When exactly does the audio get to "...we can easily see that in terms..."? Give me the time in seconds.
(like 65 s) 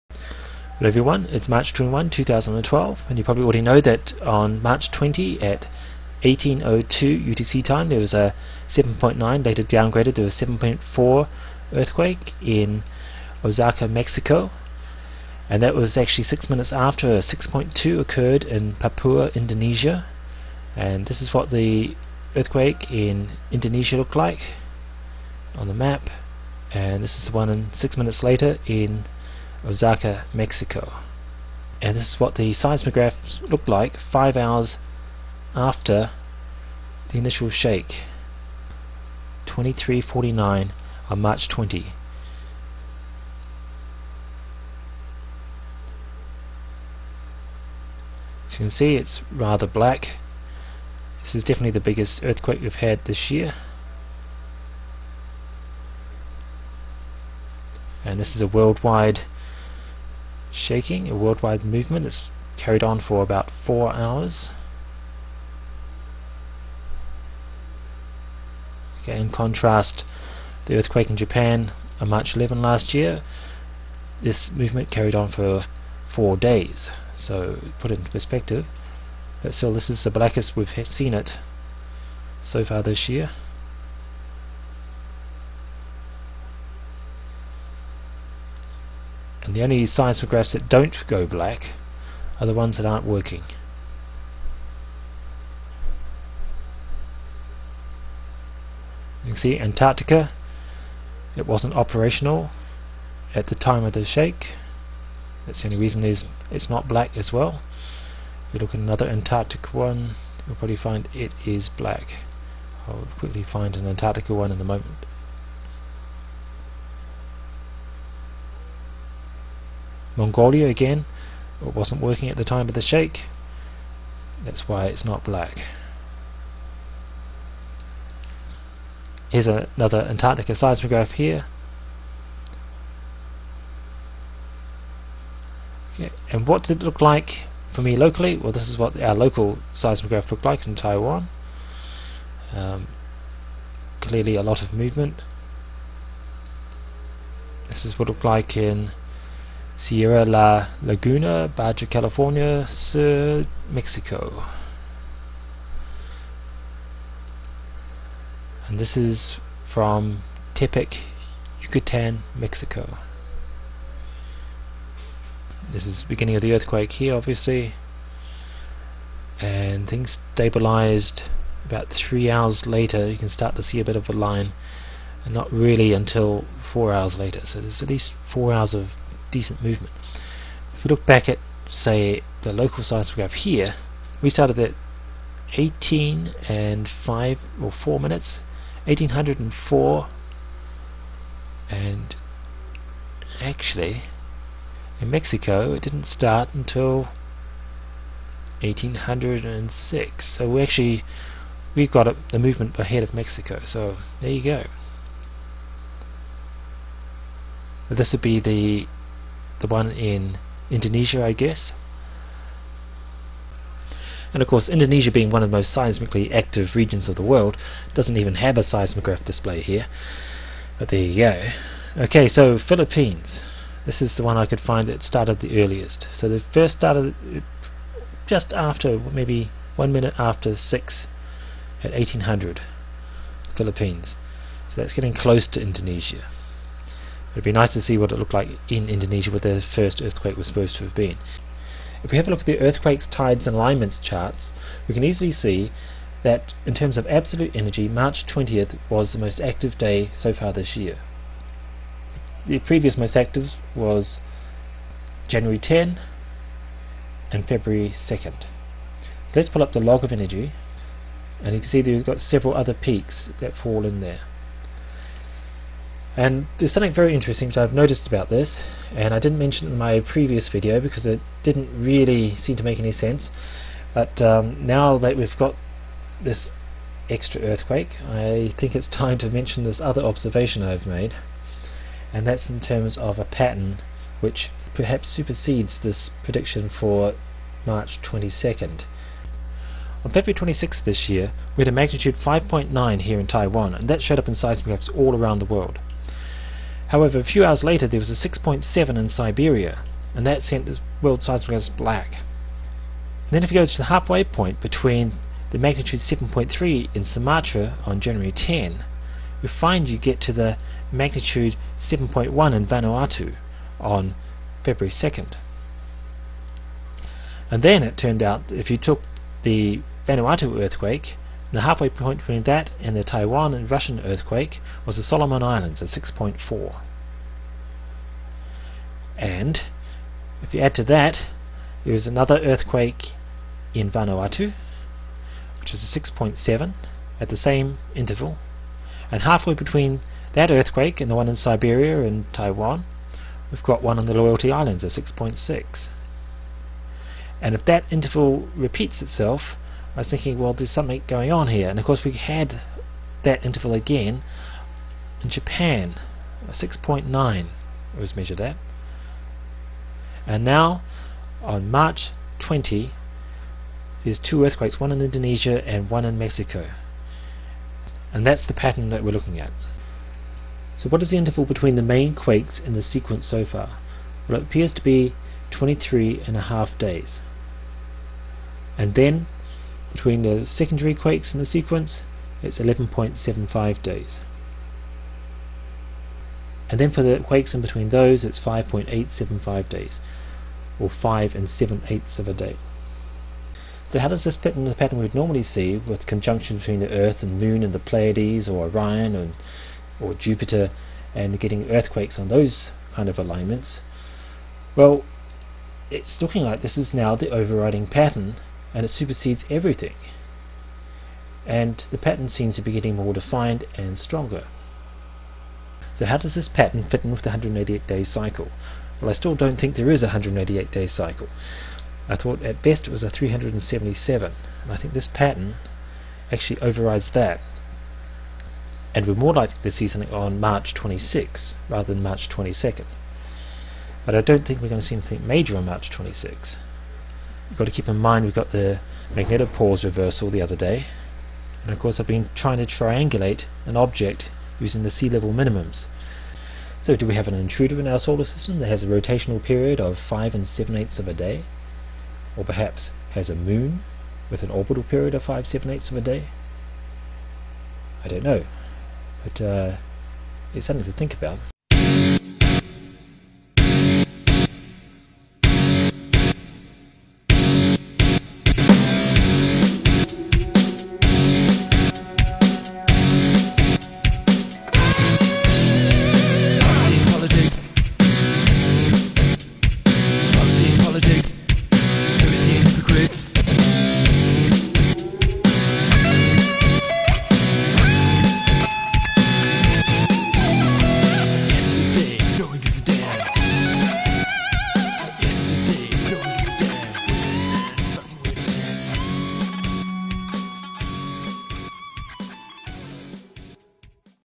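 244 s.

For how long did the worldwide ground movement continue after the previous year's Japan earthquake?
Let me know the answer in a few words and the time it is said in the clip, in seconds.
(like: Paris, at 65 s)
four days, at 76 s.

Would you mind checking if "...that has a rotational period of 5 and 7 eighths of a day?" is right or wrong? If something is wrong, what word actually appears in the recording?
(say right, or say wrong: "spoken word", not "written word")
right.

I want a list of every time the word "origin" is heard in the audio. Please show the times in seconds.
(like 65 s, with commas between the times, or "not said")
not said.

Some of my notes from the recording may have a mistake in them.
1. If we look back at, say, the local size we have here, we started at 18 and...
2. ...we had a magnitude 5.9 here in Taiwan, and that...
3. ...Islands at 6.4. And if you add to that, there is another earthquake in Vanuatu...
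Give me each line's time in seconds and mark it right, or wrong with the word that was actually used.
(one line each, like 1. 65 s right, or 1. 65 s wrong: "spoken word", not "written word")
1. 180 s right
2. 291 s right
3. 325 s right.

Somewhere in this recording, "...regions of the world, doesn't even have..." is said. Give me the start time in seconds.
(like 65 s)
216 s.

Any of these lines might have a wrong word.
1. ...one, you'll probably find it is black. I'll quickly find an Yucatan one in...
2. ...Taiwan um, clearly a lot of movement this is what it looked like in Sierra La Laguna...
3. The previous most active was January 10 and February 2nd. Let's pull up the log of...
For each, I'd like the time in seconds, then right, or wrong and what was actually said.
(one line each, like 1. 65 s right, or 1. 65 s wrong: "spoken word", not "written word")
1. 109 s wrong: "Antarctica", not "Yucatan"
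2. 140 s right
3. 252 s right.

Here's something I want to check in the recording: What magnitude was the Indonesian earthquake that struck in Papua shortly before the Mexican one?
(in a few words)
6.2.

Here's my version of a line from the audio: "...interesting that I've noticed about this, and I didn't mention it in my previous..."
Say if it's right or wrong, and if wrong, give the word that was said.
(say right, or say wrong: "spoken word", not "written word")
right.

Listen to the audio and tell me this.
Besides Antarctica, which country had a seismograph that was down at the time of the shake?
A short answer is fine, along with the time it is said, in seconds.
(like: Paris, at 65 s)
Mongolia, at 120 s.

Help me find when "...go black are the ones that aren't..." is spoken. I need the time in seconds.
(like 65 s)
91 s.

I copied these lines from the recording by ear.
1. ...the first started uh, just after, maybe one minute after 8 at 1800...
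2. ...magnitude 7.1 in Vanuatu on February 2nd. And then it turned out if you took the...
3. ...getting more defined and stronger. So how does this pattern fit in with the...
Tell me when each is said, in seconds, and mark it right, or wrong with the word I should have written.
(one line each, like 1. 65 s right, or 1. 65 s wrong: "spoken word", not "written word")
1. 226 s wrong: "6", not "8"
2. 310 s right
3. 412 s right.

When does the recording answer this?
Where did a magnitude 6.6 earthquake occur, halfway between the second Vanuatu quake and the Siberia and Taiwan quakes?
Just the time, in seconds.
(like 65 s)
344 s.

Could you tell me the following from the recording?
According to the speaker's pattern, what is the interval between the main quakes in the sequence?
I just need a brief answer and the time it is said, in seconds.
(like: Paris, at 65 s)
23.5 days, at 375 s.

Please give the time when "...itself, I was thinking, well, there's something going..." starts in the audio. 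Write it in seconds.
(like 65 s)
349 s.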